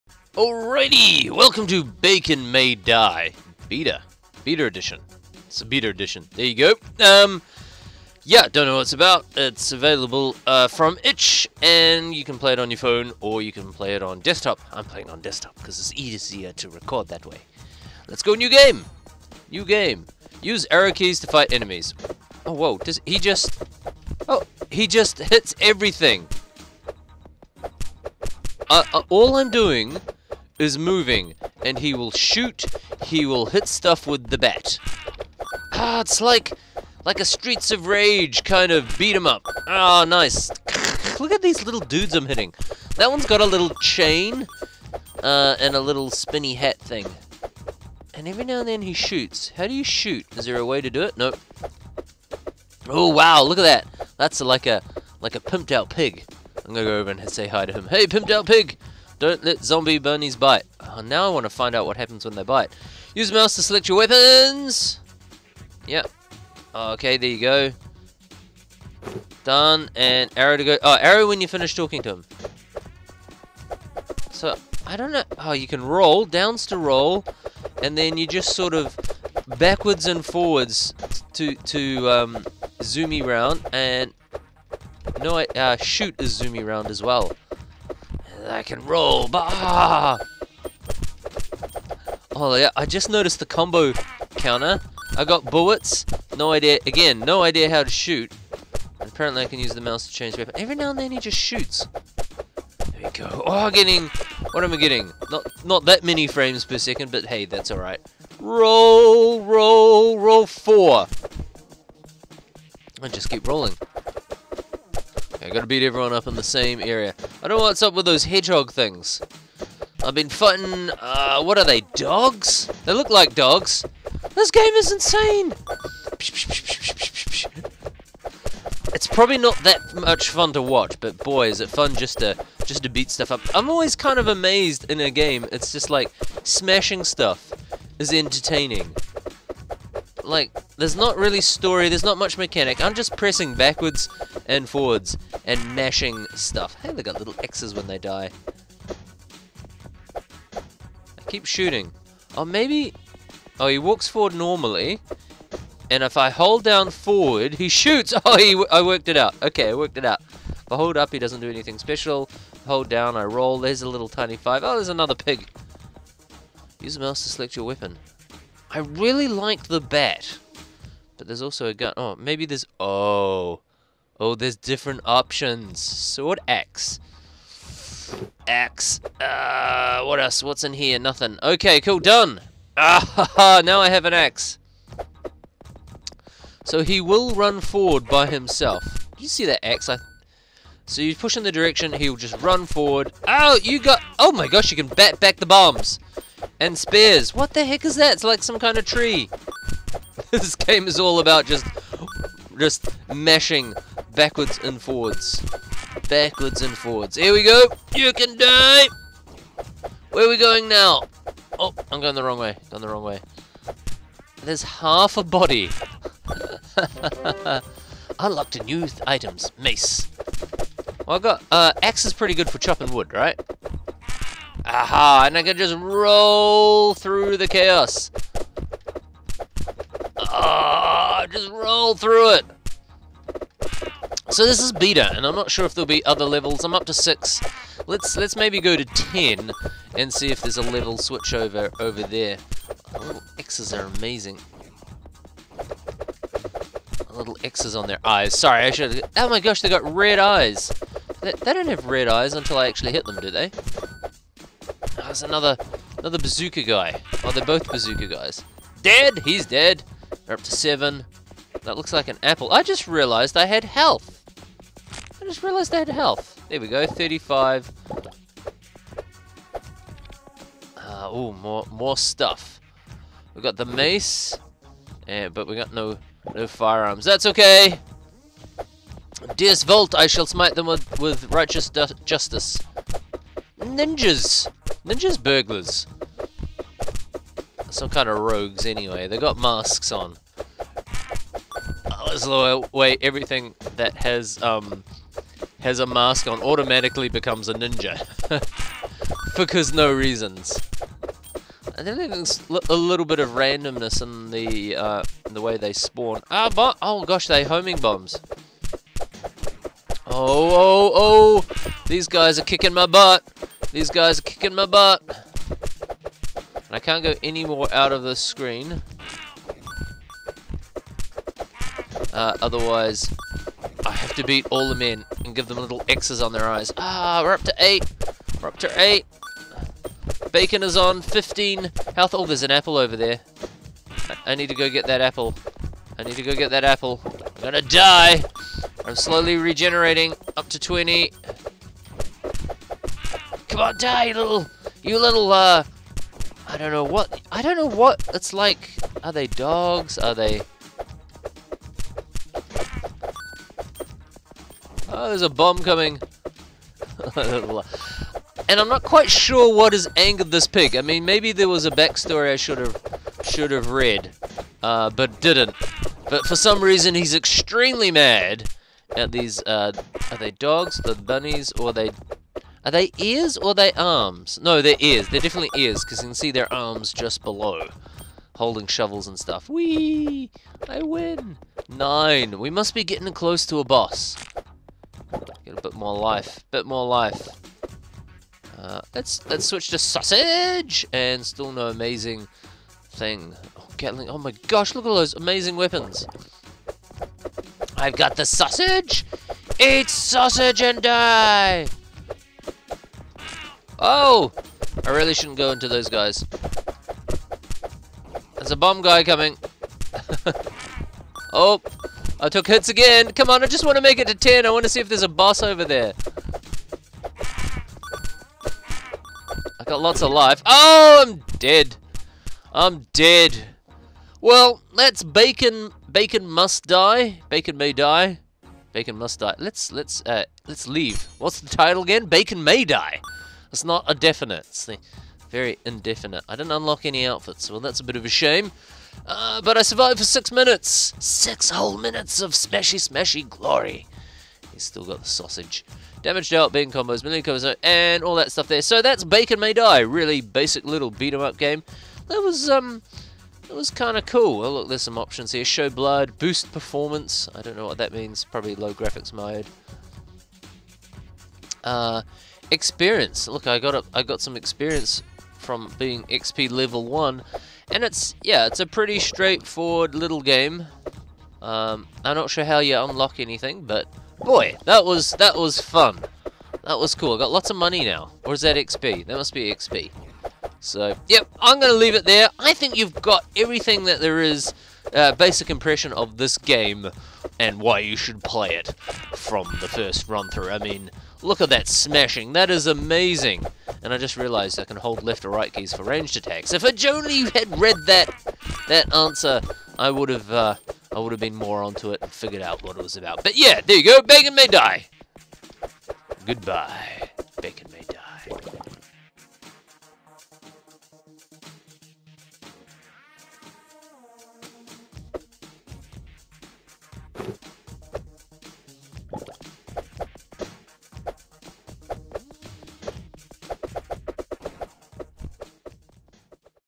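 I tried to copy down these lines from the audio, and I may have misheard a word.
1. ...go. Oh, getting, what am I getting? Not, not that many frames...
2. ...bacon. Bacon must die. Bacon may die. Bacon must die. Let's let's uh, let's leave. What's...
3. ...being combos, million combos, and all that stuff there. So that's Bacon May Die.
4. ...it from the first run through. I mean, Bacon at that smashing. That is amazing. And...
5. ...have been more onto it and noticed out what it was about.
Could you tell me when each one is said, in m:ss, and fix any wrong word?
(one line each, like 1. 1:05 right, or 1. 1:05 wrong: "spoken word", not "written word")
1. 1:43 right
2. 7:05 right
3. 7:26 right
4. 8:08 wrong: "Look", not "Bacon"
5. 8:21 wrong: "figured", not "noticed".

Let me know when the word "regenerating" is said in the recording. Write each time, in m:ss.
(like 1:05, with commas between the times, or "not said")
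5:39.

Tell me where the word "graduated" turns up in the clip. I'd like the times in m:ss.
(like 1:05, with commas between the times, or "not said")
not said.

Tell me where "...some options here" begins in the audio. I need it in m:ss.
7:34.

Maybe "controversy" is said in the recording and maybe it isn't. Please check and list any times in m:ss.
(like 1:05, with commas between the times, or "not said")
not said.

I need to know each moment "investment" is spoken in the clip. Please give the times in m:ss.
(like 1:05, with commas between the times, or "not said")
not said.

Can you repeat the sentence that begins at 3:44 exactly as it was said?
Aha, and I can just roll through the chaos.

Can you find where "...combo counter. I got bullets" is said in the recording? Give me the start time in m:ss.
1:33.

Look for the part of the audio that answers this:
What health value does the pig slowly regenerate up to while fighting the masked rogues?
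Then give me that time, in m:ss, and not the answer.
5:40.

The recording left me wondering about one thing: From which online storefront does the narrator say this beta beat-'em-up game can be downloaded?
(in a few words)
Itch.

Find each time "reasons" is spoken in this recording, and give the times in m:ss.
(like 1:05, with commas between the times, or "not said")
4:59, 6:06.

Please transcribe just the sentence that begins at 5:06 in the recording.
Ah, but oh gosh, they homing bombs.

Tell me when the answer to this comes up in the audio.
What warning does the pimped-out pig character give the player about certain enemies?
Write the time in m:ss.
0:59.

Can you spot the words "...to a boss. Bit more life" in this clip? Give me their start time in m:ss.
6:23.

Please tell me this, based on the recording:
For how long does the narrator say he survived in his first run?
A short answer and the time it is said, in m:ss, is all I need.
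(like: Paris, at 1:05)
6 minutes, at 7:20.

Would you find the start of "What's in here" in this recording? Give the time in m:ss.
3:00.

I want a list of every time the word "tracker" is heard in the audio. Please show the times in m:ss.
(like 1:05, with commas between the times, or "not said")
not said.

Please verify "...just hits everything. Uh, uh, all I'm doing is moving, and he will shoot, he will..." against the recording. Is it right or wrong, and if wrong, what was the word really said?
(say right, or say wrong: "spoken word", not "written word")
right.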